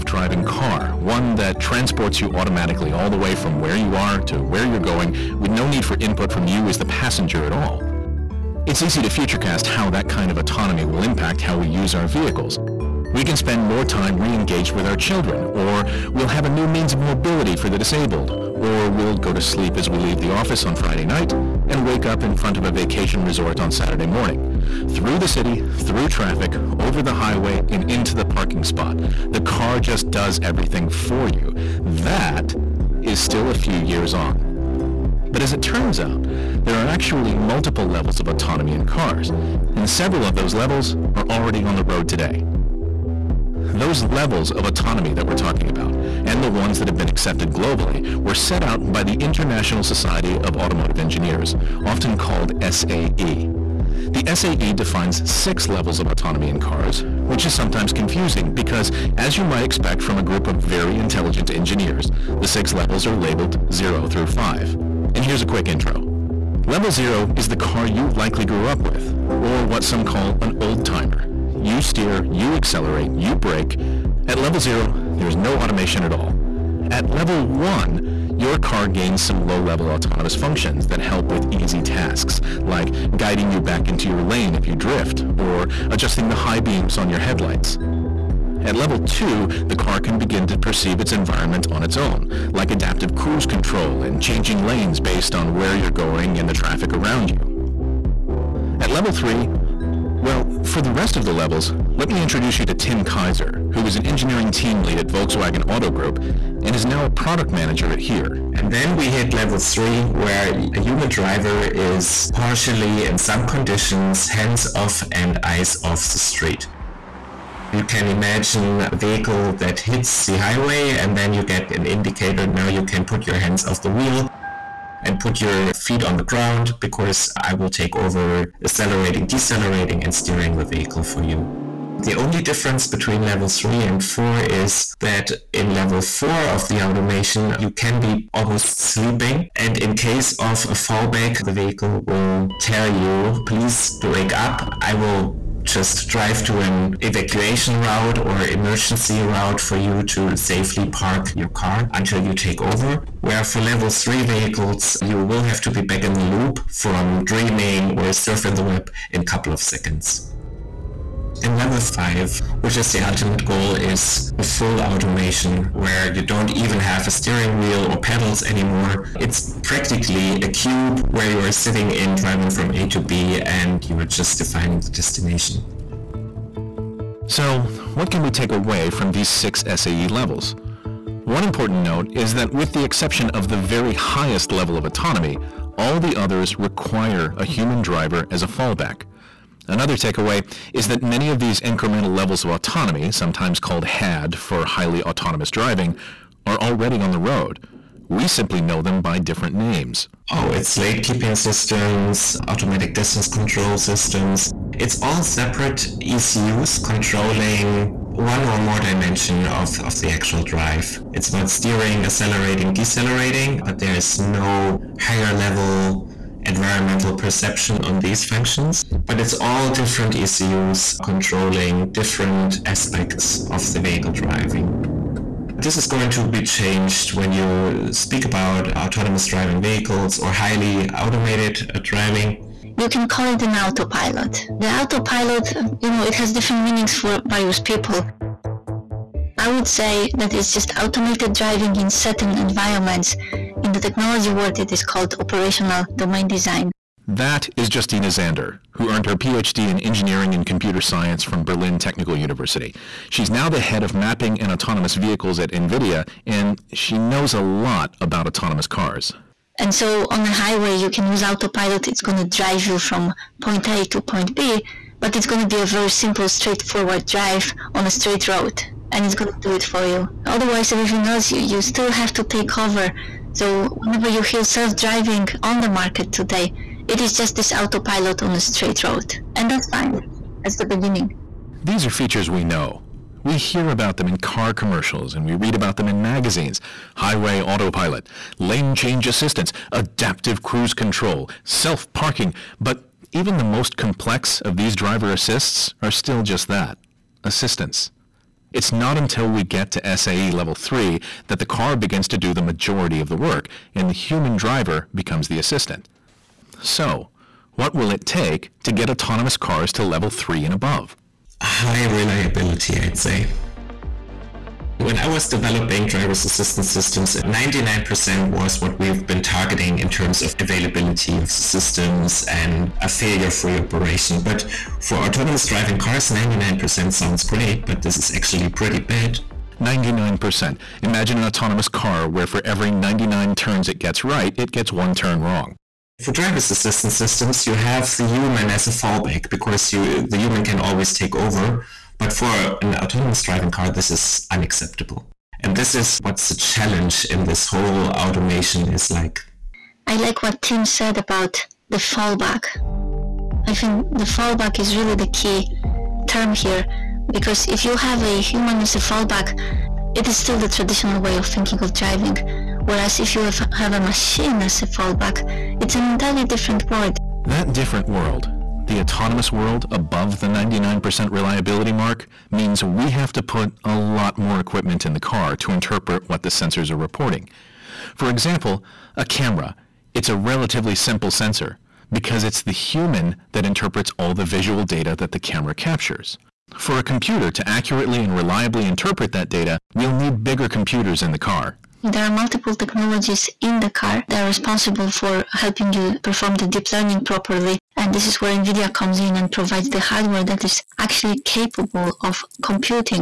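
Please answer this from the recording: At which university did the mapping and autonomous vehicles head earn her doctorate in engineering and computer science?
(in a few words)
Berlin Technical University.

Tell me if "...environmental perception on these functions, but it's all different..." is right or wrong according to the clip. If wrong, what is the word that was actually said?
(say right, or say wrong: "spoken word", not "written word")
right.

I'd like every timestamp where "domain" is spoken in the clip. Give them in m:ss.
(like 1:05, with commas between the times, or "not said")
4:05.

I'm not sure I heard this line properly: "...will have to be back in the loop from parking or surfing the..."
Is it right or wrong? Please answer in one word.
wrong.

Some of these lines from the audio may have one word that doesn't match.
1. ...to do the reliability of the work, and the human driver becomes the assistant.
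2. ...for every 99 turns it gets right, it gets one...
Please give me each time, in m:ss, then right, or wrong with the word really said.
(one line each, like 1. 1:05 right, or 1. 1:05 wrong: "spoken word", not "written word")
1. 5:02 wrong: "majority", not "reliability"
2. 5:32 right.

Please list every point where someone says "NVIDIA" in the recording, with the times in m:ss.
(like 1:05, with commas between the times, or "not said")
4:15, 6:38.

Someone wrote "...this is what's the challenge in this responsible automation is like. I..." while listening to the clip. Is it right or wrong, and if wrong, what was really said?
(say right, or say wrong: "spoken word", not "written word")
wrong: "whole", not "responsible".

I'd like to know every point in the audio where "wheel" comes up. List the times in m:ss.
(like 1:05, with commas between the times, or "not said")
2:03, 2:47.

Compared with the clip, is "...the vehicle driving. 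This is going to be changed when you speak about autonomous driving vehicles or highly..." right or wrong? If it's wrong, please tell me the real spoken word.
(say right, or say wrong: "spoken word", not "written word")
right.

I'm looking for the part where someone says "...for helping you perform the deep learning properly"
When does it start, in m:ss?
6:34.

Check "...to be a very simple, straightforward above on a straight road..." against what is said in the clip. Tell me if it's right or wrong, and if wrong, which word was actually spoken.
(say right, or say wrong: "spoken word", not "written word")
wrong: "drive", not "above".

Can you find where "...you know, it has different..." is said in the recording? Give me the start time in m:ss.
3:55.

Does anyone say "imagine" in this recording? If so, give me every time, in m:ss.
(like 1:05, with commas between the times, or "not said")
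1:58, 5:30.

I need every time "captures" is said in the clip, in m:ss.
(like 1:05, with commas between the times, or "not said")
6:25.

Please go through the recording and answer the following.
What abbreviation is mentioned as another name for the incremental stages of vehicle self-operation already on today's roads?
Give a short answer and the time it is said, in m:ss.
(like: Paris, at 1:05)
HAD, at 3:13.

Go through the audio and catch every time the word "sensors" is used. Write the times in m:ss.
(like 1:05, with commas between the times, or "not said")
6:16, 6:21.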